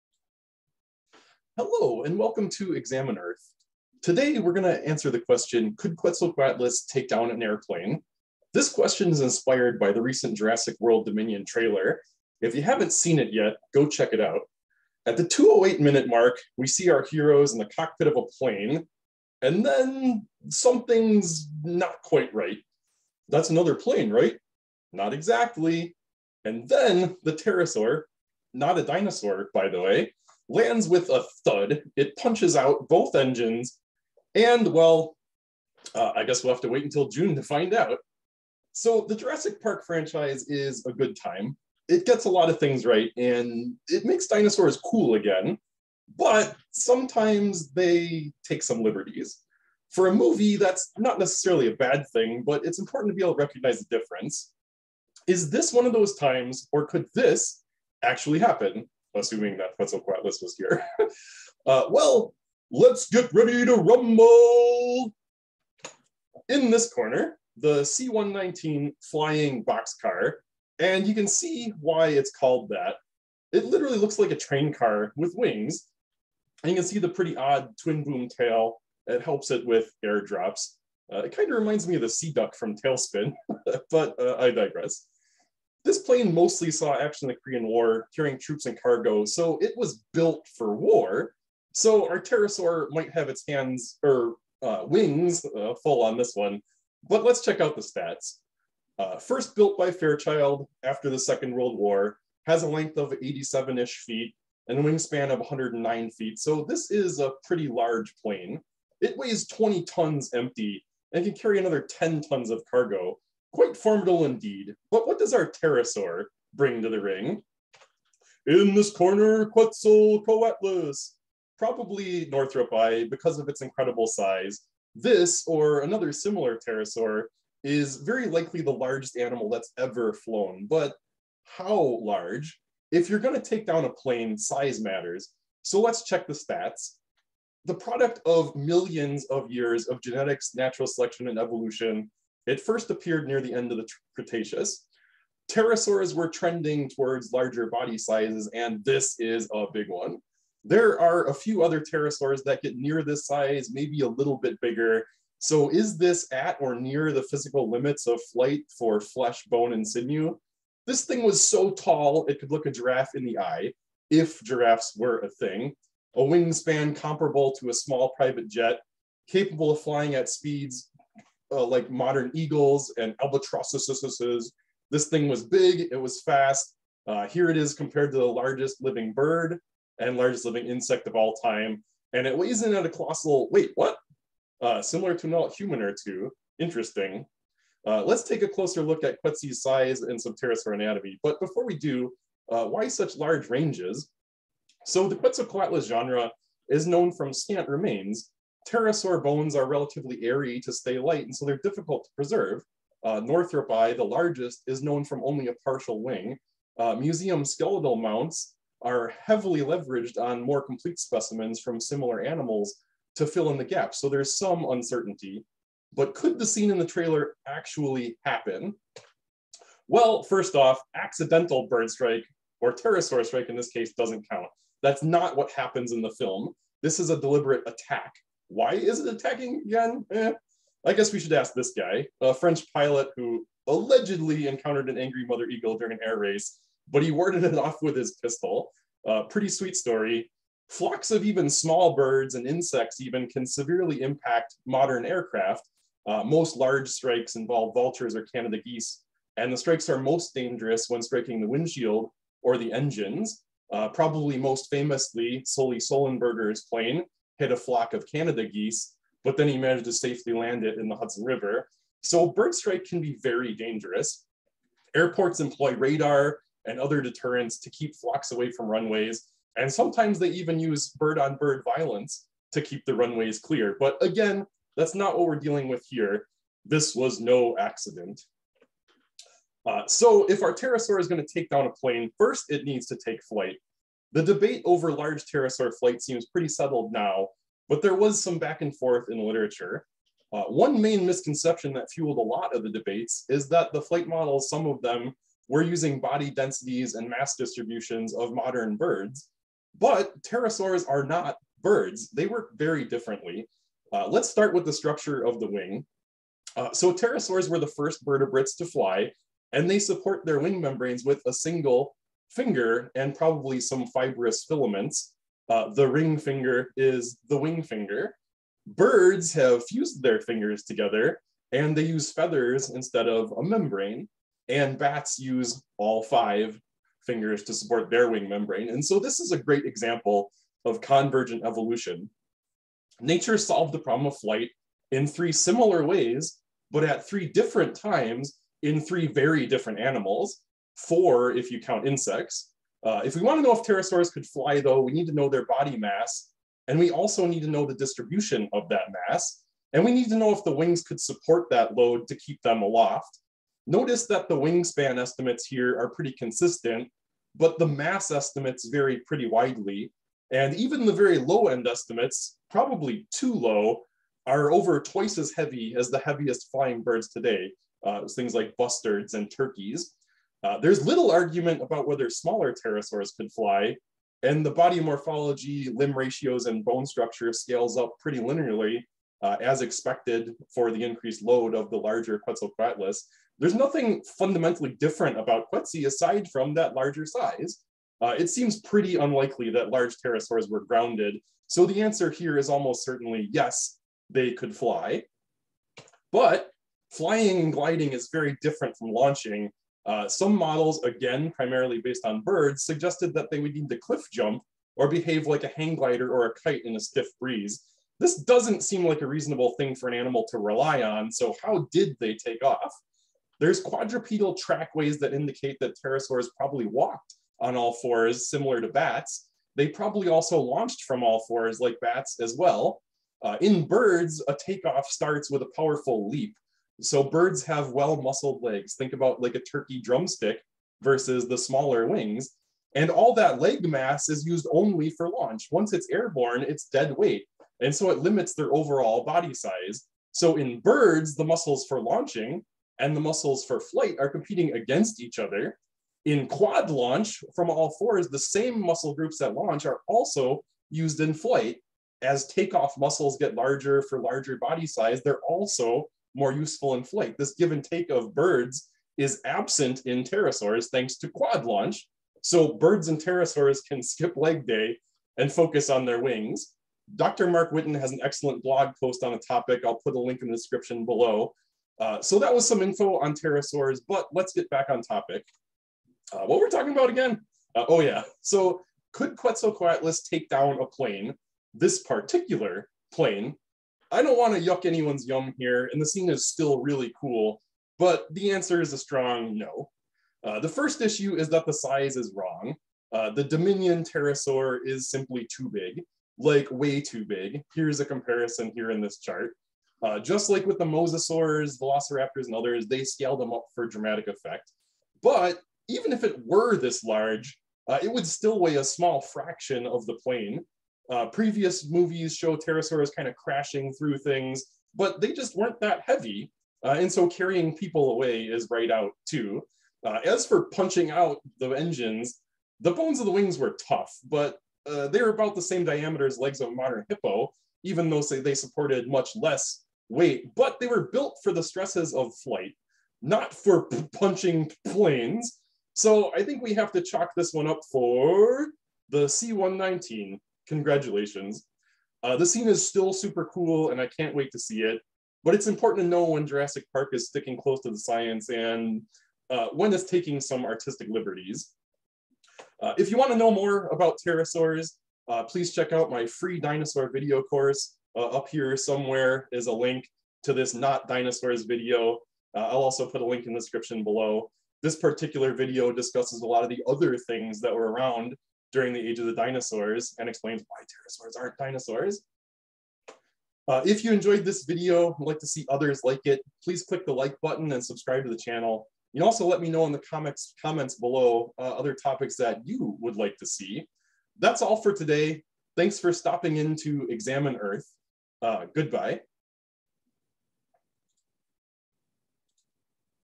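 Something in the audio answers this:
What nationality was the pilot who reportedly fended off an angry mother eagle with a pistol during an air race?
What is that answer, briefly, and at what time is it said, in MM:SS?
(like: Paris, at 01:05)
French, at 03:52.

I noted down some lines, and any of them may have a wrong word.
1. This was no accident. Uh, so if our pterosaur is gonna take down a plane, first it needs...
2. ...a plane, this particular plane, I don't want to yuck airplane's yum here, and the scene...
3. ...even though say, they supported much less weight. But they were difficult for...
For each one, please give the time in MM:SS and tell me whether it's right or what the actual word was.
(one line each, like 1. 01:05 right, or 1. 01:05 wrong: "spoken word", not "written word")
1. 04:36 right
2. 08:00 wrong: "anyone", not "airplane"
3. 08:47 wrong: "built", not "difficult".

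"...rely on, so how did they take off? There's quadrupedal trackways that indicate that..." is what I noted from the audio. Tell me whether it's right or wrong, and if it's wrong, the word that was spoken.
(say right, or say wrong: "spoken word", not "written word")
right.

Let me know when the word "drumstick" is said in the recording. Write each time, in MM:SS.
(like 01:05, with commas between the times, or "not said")
07:09.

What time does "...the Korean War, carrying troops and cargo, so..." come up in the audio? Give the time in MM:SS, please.
01:27.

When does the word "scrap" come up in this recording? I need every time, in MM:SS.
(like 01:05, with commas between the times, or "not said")
not said.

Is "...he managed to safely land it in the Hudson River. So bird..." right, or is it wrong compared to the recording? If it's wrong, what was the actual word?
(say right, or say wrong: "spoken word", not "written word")
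right.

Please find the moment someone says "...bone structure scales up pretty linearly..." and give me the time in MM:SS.
06:16.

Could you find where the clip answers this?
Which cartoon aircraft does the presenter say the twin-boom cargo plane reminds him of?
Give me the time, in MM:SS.
01:22.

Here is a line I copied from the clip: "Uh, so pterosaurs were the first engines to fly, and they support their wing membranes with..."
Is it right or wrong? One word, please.
wrong.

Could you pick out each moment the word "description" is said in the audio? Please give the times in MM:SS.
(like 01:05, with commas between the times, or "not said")
07:50, 09:23.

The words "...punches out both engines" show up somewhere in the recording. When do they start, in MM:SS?
00:32.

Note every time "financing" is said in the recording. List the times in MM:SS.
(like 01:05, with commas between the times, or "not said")
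not said.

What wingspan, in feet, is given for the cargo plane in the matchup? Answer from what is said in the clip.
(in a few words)
109 feet.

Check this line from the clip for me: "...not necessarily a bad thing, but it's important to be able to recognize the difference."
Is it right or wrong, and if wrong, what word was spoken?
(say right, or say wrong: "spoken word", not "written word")
right.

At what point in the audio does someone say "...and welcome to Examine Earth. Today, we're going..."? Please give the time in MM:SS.
00:02.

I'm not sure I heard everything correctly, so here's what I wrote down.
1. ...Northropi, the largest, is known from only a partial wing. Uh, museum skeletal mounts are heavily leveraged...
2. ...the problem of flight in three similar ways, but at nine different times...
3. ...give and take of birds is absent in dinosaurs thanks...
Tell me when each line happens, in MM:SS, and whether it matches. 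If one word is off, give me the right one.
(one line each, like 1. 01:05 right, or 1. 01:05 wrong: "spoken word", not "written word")
1. 03:23 right
2. 05:33 wrong: "three", not "nine"
3. 07:37 wrong: "pterosaurs", not "dinosaurs".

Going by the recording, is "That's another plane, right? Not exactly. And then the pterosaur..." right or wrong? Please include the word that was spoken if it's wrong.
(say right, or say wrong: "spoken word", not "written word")
right.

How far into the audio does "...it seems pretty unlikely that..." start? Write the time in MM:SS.
06:28.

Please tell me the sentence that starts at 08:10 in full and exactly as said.
Uh, the first issue is that the size is wrong.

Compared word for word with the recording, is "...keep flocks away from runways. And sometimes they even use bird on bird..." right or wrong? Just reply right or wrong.
right.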